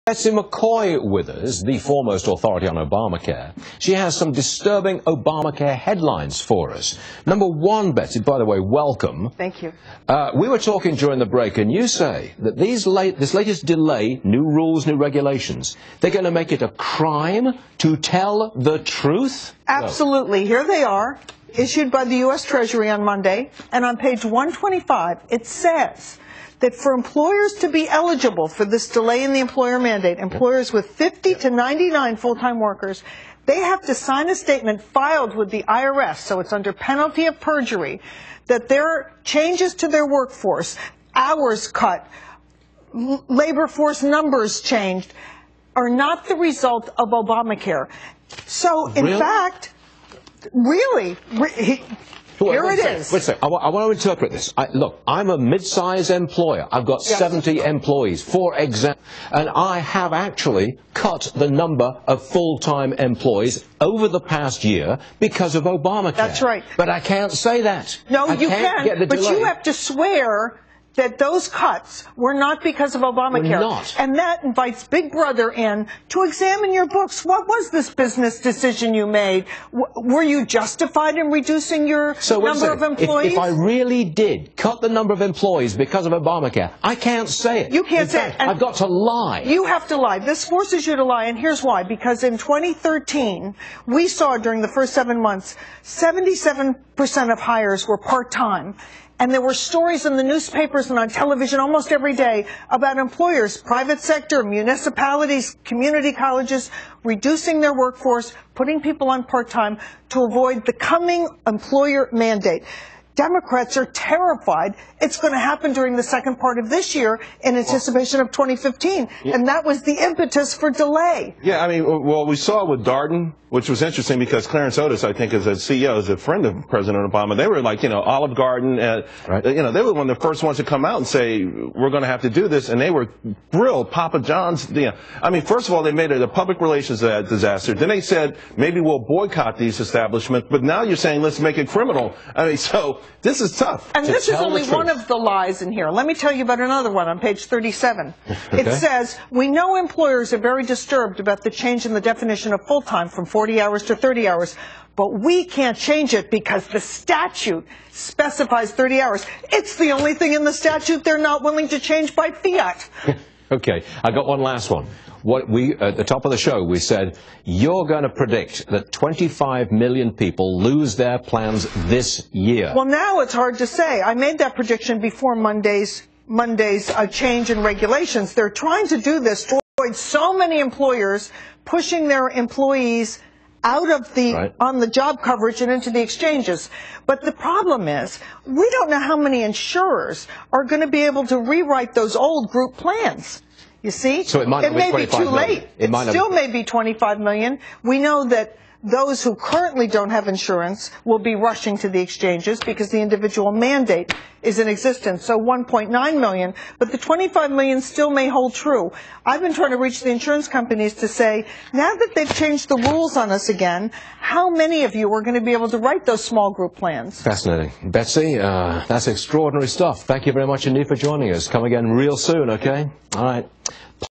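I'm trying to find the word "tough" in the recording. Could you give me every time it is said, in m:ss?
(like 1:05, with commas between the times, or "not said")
2:23.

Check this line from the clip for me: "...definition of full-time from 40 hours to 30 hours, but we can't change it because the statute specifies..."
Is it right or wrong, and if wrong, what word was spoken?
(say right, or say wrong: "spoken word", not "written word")
right.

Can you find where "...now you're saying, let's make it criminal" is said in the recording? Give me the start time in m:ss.
2:20.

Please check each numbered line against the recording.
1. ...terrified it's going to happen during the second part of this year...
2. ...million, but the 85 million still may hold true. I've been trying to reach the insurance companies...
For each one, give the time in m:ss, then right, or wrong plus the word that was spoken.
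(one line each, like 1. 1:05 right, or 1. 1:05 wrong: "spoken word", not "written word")
1. 1:53 right
2. 3:26 wrong: "25", not "85".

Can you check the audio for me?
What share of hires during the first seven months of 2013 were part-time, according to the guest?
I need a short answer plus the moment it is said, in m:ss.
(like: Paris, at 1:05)
77 percent, at 1:35.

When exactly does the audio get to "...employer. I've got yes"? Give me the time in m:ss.
0:56.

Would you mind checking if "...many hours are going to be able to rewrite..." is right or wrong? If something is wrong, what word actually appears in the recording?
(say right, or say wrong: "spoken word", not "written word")
wrong: "insurers", not "hours".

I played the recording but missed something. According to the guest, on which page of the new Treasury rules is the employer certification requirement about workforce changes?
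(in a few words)
125.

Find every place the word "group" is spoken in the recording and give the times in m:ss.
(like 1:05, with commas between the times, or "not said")
3:12, 3:36.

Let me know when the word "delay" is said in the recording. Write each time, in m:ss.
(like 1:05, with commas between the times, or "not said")
0:13, 0:28, 1:09, 2:00.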